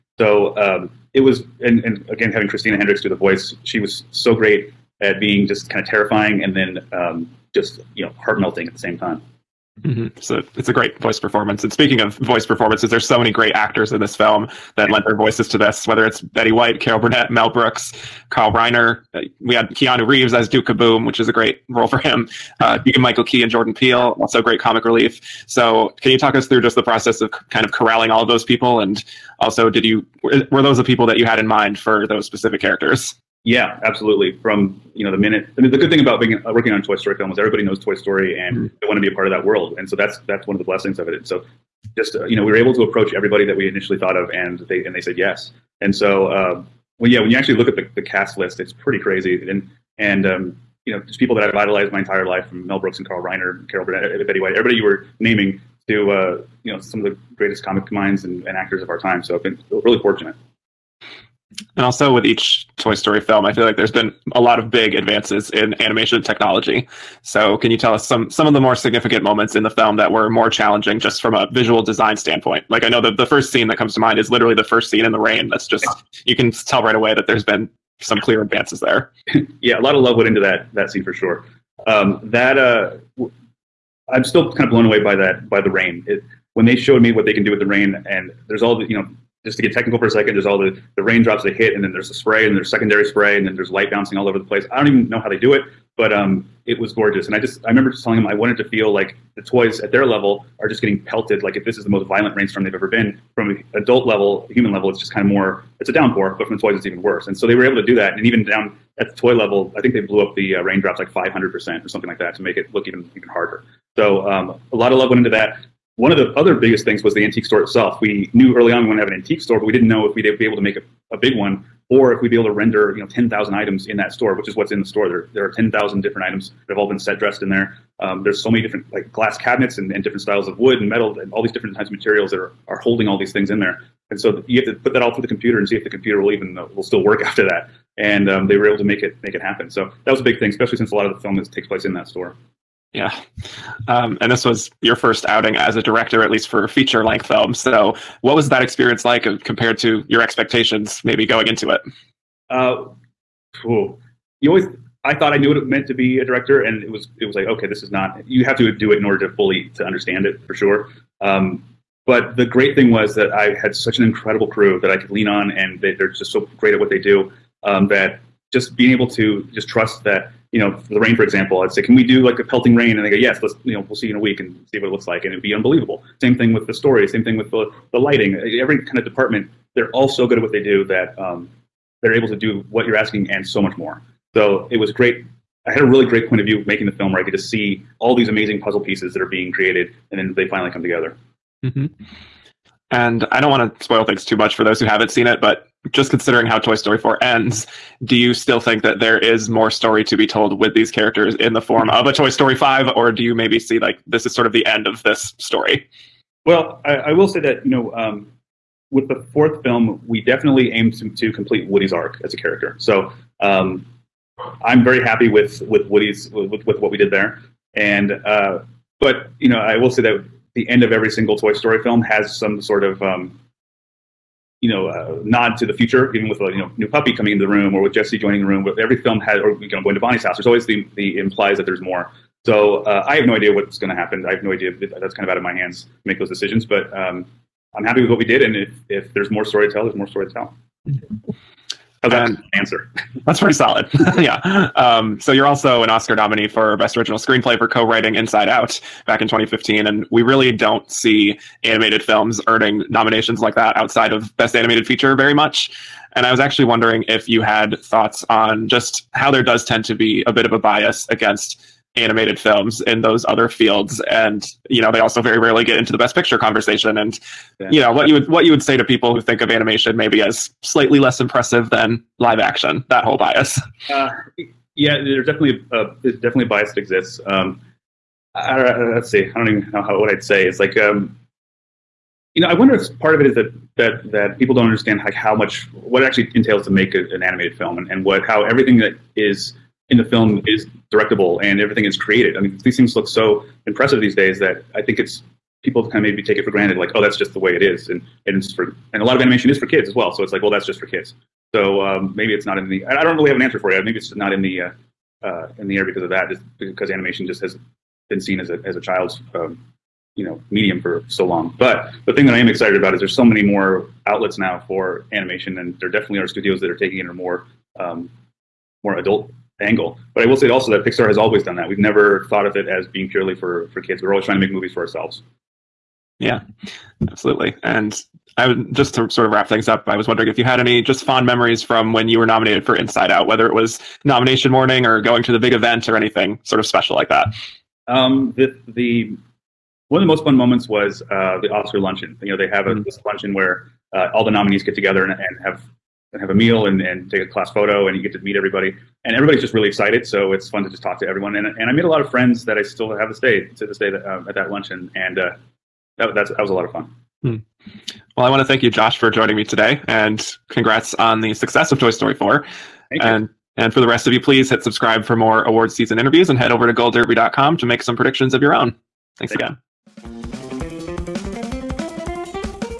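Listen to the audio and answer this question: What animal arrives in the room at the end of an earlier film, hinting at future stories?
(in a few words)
puppy.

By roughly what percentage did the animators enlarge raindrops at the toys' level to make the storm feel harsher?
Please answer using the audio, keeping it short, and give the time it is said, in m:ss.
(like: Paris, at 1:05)
500%, at 1:51.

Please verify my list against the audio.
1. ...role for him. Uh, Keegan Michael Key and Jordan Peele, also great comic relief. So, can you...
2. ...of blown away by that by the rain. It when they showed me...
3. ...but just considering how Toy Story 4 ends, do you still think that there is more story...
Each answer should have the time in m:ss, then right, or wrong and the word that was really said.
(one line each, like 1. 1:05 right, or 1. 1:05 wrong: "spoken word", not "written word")
1. 0:21 right
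2. 1:24 right
3. 3:15 right.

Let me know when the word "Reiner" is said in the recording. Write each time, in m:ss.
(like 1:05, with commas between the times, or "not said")
0:18, 0:53.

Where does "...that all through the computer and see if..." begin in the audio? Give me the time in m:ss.
2:14.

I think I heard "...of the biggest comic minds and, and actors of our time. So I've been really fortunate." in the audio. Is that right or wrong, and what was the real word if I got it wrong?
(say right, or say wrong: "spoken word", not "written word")
wrong: "greatest", not "biggest".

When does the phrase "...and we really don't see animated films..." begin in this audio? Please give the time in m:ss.
4:09.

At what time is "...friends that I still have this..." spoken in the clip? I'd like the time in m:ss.
5:52.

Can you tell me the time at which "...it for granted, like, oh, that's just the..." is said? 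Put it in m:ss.
4:56.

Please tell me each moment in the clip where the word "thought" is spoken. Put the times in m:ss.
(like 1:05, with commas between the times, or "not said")
0:43, 2:35, 4:17, 5:22.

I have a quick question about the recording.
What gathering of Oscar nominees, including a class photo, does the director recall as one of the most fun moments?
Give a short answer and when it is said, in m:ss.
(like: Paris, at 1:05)
Oscar luncheon, at 5:41.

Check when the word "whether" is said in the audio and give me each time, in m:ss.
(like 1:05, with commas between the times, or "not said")
0:15, 5:33.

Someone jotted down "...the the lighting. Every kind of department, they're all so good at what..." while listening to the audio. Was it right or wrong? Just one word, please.
right.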